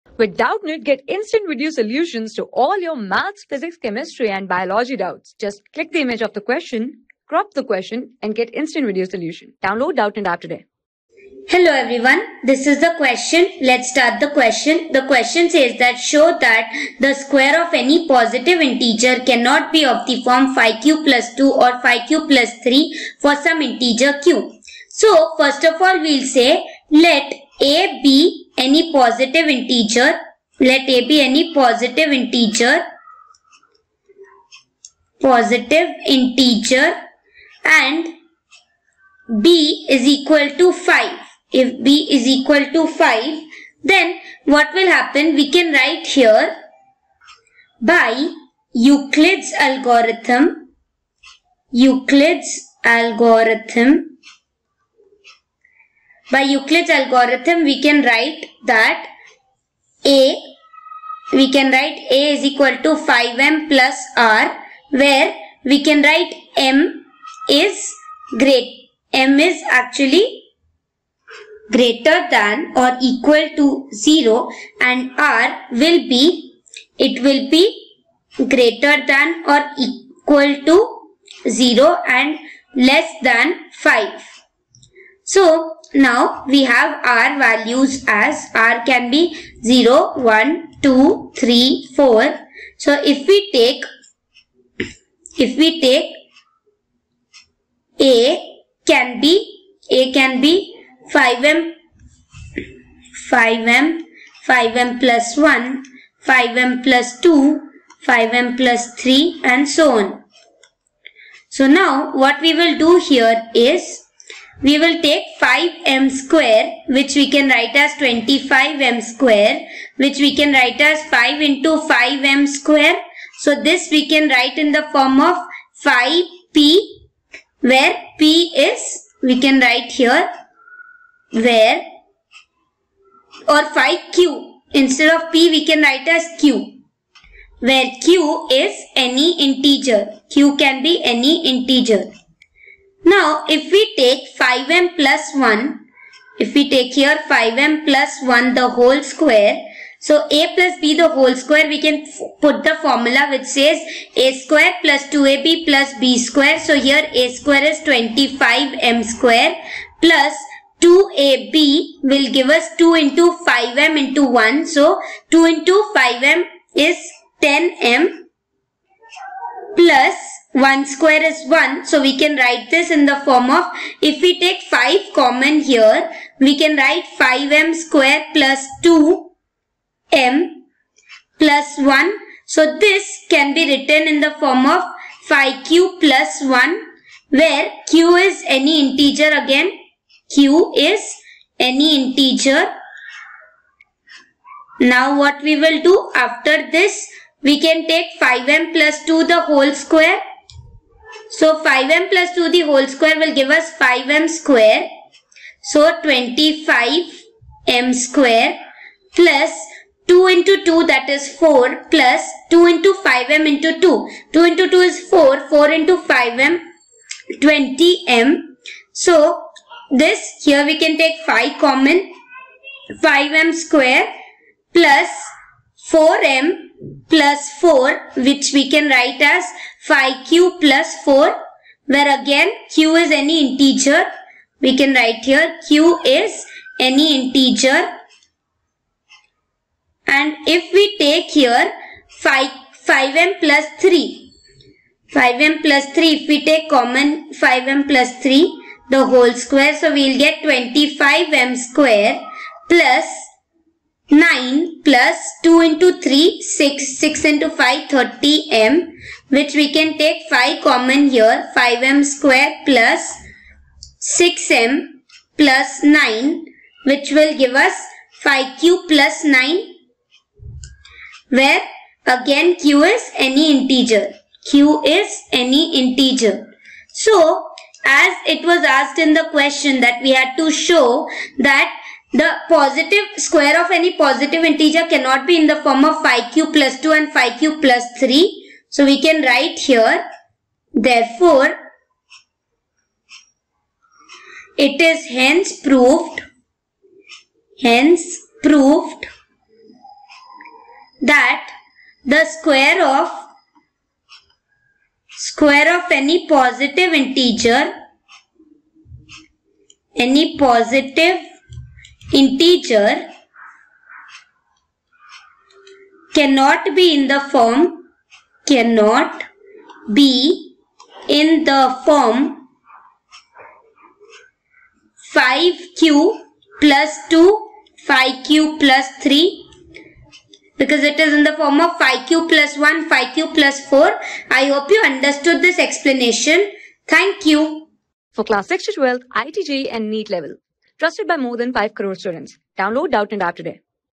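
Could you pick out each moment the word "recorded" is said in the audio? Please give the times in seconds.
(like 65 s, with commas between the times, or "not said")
not said.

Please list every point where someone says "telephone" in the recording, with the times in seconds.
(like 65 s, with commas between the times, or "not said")
not said.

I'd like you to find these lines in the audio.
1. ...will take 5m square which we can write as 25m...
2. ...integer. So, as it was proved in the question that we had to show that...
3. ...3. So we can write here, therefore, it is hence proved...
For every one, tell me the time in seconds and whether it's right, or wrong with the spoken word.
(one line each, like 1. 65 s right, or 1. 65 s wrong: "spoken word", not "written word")
1. 114 s right
2. 275 s wrong: "asked", not "proved"
3. 287 s right.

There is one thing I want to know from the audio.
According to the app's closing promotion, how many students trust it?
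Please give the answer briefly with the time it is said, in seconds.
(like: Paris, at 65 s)
more than 5 crore, at 341 s.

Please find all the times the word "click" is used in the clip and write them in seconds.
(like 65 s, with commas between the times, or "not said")
5 s.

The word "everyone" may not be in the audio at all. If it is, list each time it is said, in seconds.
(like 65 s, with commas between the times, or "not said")
11 s.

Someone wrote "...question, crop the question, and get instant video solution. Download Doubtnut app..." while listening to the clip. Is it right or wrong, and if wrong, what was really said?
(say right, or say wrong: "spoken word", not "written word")
right.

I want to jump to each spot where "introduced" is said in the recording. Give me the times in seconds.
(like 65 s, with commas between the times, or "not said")
not said.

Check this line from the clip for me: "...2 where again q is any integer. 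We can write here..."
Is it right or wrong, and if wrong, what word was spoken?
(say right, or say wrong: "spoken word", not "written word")
wrong: "4", not "2".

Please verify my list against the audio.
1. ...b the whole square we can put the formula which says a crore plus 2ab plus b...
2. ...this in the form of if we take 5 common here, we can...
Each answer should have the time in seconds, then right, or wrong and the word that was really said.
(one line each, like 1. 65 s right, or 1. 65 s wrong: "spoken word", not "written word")
1. 150 s wrong: "square", not "crore"
2. 172 s right.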